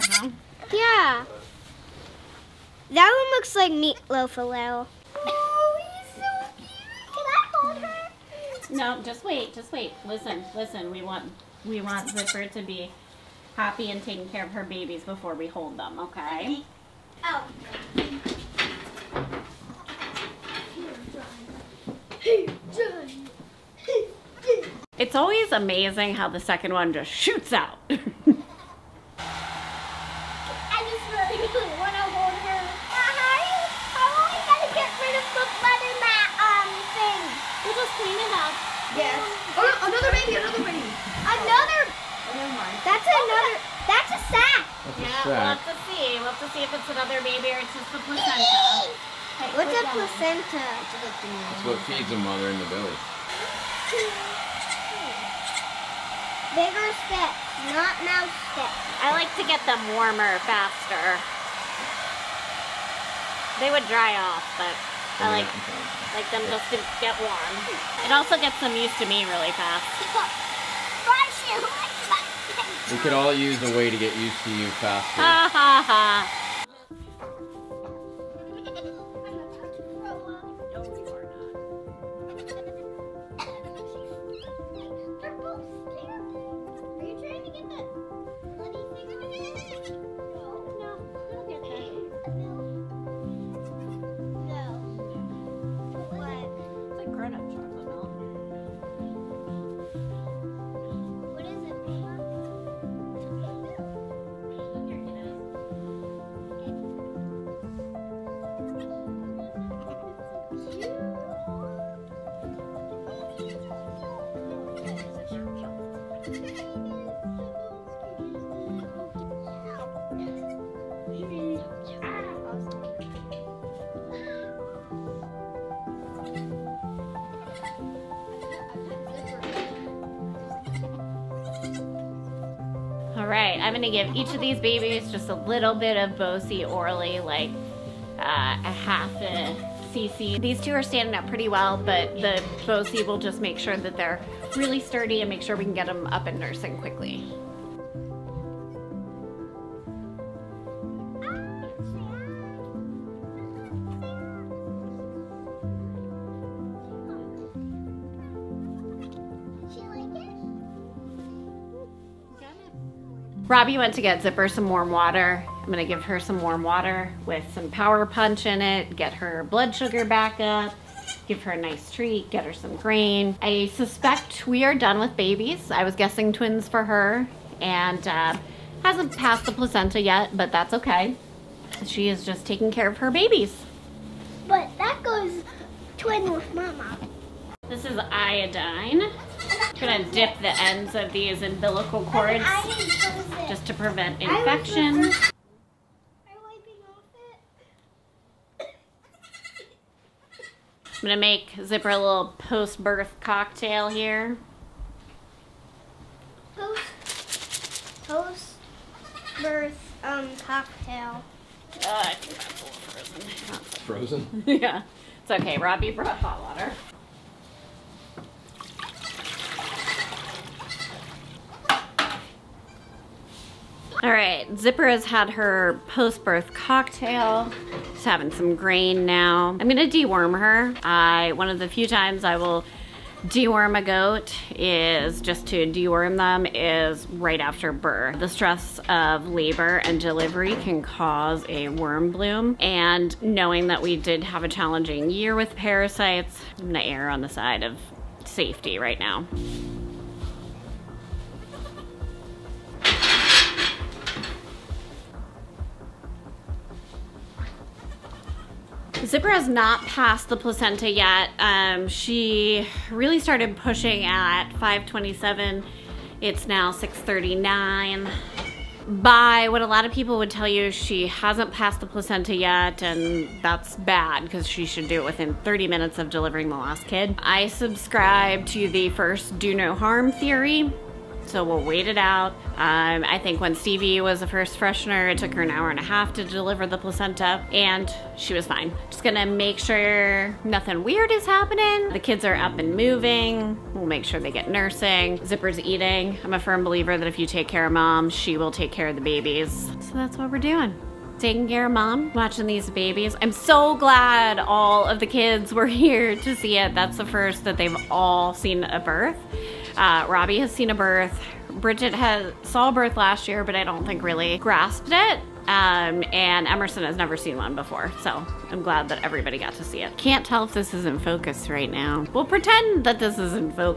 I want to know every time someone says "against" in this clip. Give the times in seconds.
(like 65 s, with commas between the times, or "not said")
not said.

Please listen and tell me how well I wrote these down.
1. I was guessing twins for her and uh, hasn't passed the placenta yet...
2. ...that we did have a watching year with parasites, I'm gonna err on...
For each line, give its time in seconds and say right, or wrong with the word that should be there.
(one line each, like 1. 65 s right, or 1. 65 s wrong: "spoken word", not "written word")
1. 175 s right
2. 243 s wrong: "challenging", not "watching".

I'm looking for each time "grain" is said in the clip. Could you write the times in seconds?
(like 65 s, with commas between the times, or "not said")
172 s, 228 s.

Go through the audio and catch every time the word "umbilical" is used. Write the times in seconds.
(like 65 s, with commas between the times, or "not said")
191 s.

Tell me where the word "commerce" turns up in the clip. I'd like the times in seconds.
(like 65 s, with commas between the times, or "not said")
not said.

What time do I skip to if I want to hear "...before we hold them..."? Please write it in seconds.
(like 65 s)
15 s.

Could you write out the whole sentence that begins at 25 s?
It's always amazing how the second one just shoots out.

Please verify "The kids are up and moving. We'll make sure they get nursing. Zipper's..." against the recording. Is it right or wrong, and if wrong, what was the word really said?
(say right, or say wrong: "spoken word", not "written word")
right.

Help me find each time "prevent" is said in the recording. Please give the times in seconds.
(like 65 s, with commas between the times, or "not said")
193 s.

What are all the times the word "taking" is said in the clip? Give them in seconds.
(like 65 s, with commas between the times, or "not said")
14 s, 182 s, 301 s.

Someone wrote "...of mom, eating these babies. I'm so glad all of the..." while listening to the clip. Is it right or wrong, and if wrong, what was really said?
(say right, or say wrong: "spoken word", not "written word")
wrong: "watching", not "eating".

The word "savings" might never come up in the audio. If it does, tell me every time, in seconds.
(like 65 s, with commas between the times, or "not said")
not said.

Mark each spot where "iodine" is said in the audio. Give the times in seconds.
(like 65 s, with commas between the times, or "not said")
187 s.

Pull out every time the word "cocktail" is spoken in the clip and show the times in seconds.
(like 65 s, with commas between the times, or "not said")
203 s, 210 s, 226 s.